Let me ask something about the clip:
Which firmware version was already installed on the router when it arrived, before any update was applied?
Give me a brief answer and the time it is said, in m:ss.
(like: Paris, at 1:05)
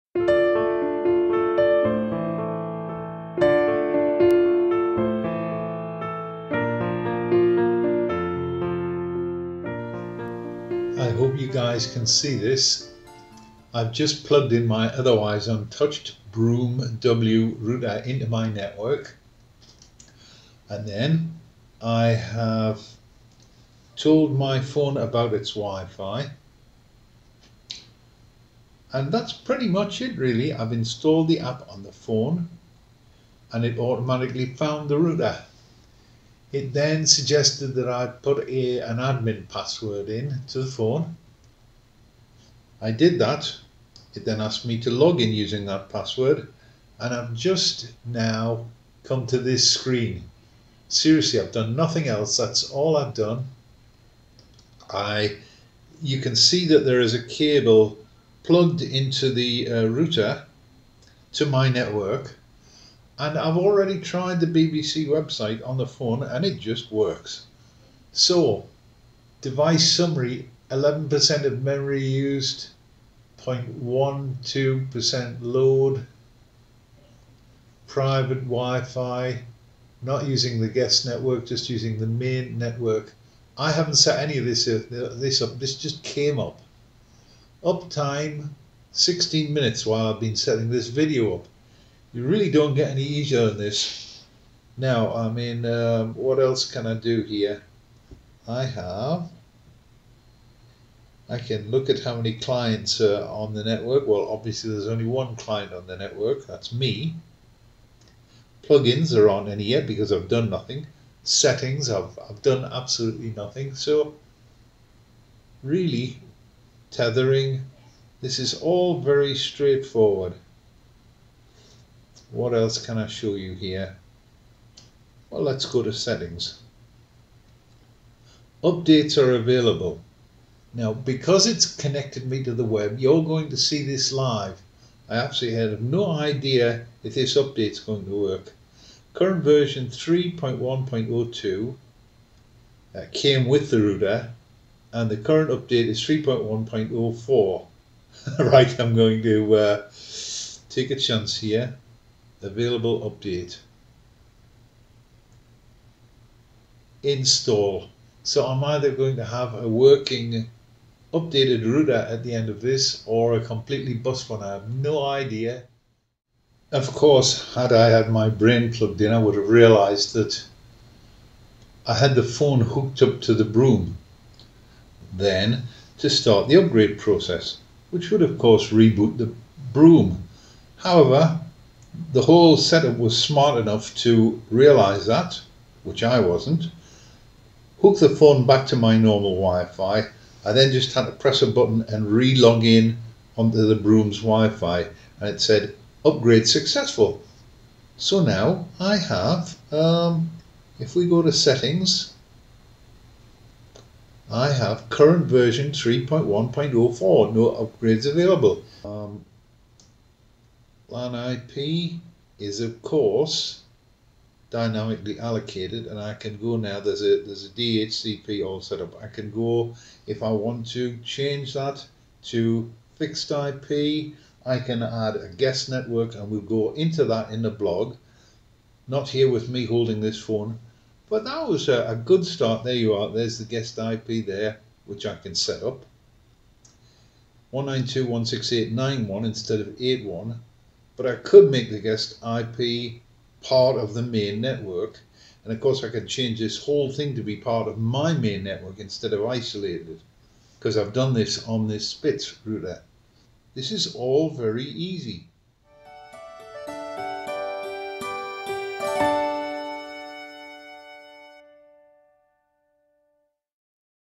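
3.1.02, at 2:19.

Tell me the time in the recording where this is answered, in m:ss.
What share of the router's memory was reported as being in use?
1:10.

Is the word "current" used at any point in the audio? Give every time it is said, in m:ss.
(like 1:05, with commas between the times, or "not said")
2:19, 2:25, 3:24.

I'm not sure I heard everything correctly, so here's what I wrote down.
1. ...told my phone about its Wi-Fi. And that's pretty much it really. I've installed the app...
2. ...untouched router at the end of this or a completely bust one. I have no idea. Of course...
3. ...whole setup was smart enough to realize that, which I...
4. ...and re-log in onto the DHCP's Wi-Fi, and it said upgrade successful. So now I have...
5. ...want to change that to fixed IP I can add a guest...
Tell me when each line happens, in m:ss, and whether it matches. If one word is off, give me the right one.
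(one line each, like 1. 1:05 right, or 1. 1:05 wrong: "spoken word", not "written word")
1. 0:23 right
2. 2:41 wrong: "updated", not "untouched"
3. 3:02 right
4. 3:11 wrong: "Brume", not "DHCP"
5. 3:40 right.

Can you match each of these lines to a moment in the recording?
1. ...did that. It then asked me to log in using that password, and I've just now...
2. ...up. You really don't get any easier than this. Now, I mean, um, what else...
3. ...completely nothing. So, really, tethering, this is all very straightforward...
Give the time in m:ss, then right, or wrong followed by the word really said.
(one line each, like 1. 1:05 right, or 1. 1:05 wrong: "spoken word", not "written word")
1. 0:42 right
2. 1:31 right
3. 1:52 wrong: "absolutely", not "completely".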